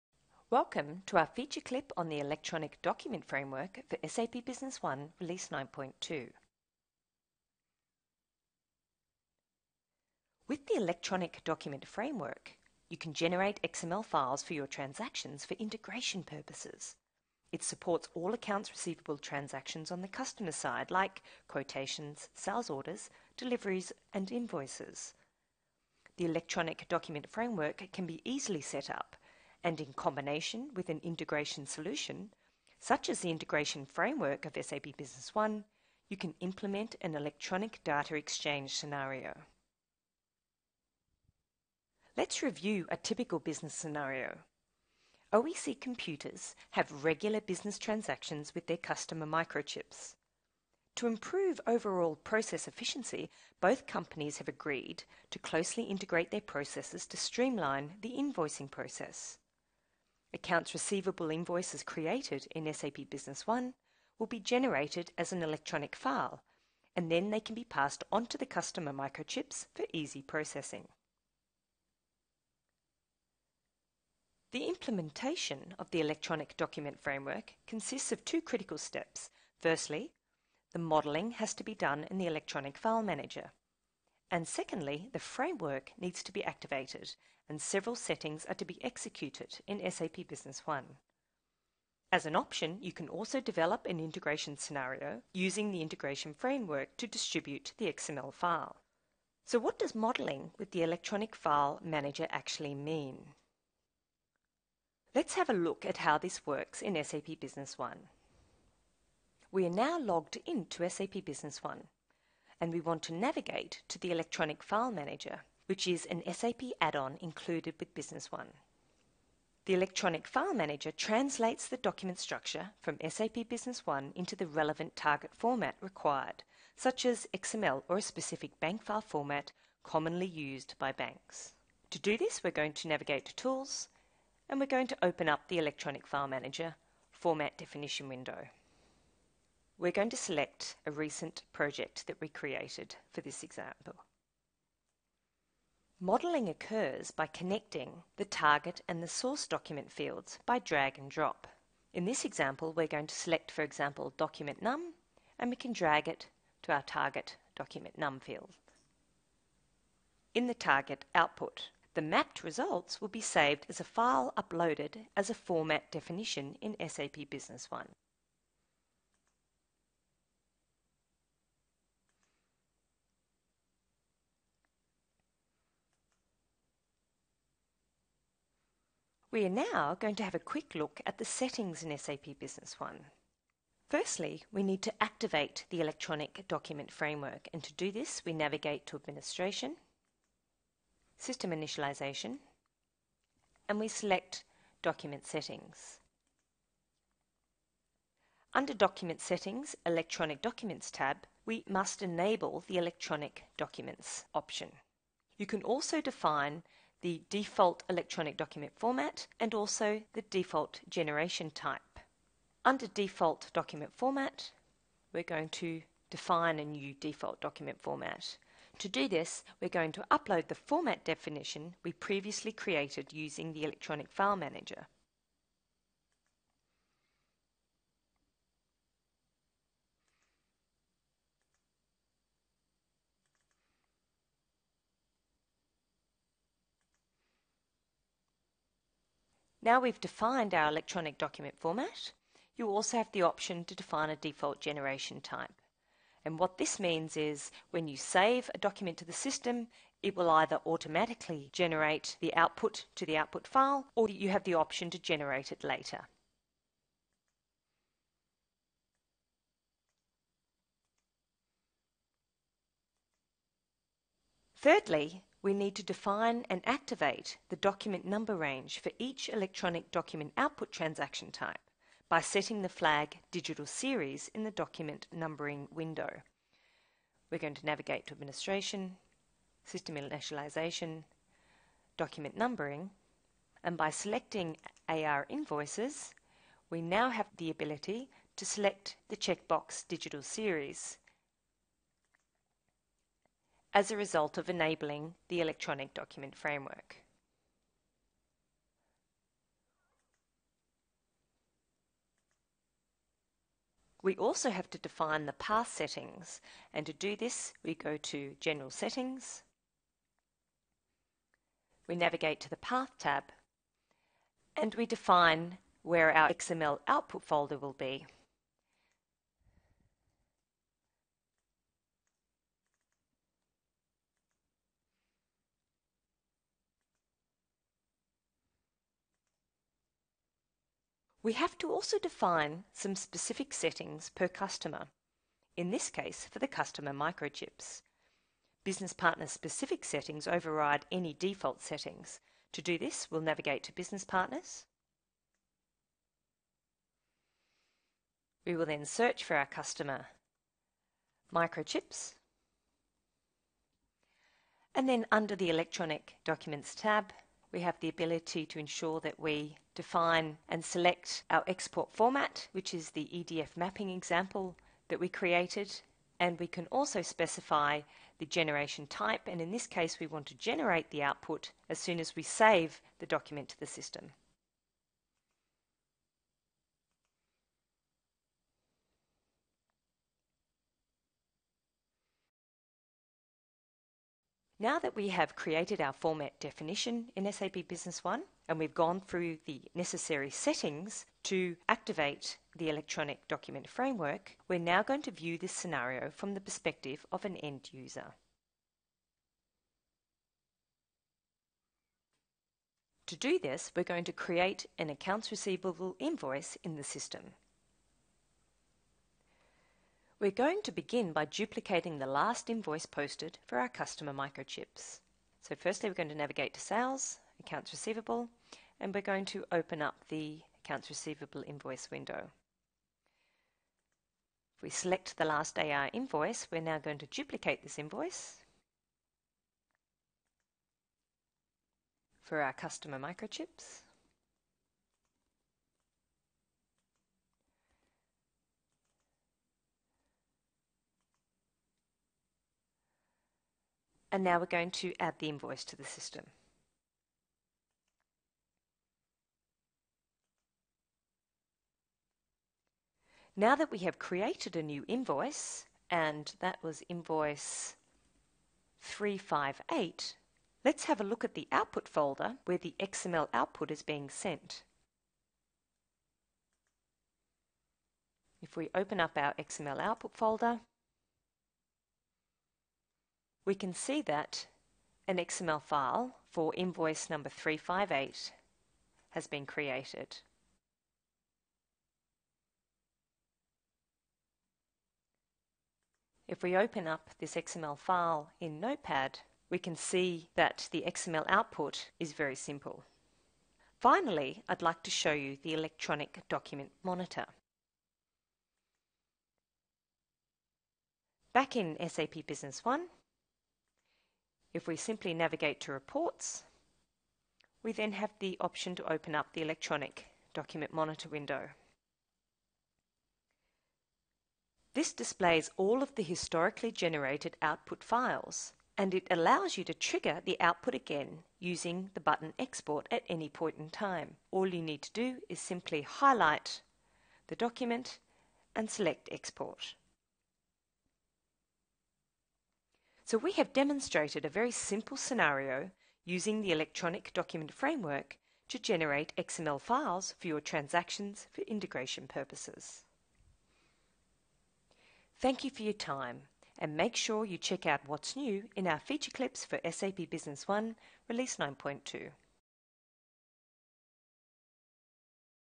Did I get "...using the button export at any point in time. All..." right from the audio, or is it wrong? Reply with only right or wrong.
right.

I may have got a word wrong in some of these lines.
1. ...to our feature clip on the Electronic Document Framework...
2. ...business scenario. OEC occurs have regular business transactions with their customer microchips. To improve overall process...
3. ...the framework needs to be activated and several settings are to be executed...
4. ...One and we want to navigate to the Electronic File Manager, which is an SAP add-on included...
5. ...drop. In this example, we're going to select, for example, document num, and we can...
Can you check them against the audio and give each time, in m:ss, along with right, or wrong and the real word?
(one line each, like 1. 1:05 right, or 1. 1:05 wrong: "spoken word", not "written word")
1. 0:01 right
2. 0:43 wrong: "computers", not "occurs"
3. 1:25 right
4. 1:51 right
5. 2:31 right.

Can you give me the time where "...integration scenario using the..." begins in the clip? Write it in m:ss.
1:33.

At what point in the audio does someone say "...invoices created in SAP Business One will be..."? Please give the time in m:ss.
1:01.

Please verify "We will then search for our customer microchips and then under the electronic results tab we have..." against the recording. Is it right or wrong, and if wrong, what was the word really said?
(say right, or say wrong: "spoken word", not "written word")
wrong: "documents", not "results".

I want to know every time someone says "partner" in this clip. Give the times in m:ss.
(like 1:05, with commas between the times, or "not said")
5:38, 5:44.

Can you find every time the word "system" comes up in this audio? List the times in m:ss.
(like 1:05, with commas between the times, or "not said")
3:11, 4:09, 4:39, 6:13, 6:46, 7:25.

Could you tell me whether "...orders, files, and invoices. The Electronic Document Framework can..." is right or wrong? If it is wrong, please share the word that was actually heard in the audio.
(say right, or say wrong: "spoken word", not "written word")
wrong: "deliveries", not "files".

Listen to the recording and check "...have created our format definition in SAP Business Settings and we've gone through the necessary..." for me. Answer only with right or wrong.
wrong.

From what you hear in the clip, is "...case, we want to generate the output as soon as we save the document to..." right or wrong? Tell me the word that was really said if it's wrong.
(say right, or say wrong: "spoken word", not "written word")
right.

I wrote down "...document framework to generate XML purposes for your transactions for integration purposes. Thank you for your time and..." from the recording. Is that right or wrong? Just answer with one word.
wrong.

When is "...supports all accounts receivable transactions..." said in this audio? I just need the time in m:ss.
0:17.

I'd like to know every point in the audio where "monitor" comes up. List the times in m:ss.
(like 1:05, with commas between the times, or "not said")
8:16, 8:30.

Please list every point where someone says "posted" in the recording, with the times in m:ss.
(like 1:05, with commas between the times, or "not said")
6:52.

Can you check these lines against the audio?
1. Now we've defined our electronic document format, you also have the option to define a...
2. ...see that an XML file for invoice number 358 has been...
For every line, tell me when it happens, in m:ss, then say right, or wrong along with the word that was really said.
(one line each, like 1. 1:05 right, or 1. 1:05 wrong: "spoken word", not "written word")
1. 3:59 right
2. 7:53 right.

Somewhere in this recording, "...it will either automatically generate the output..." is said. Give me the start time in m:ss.
4:10.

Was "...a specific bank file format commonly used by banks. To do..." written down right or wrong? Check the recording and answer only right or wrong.
right.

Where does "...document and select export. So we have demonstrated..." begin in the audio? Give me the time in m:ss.
8:47.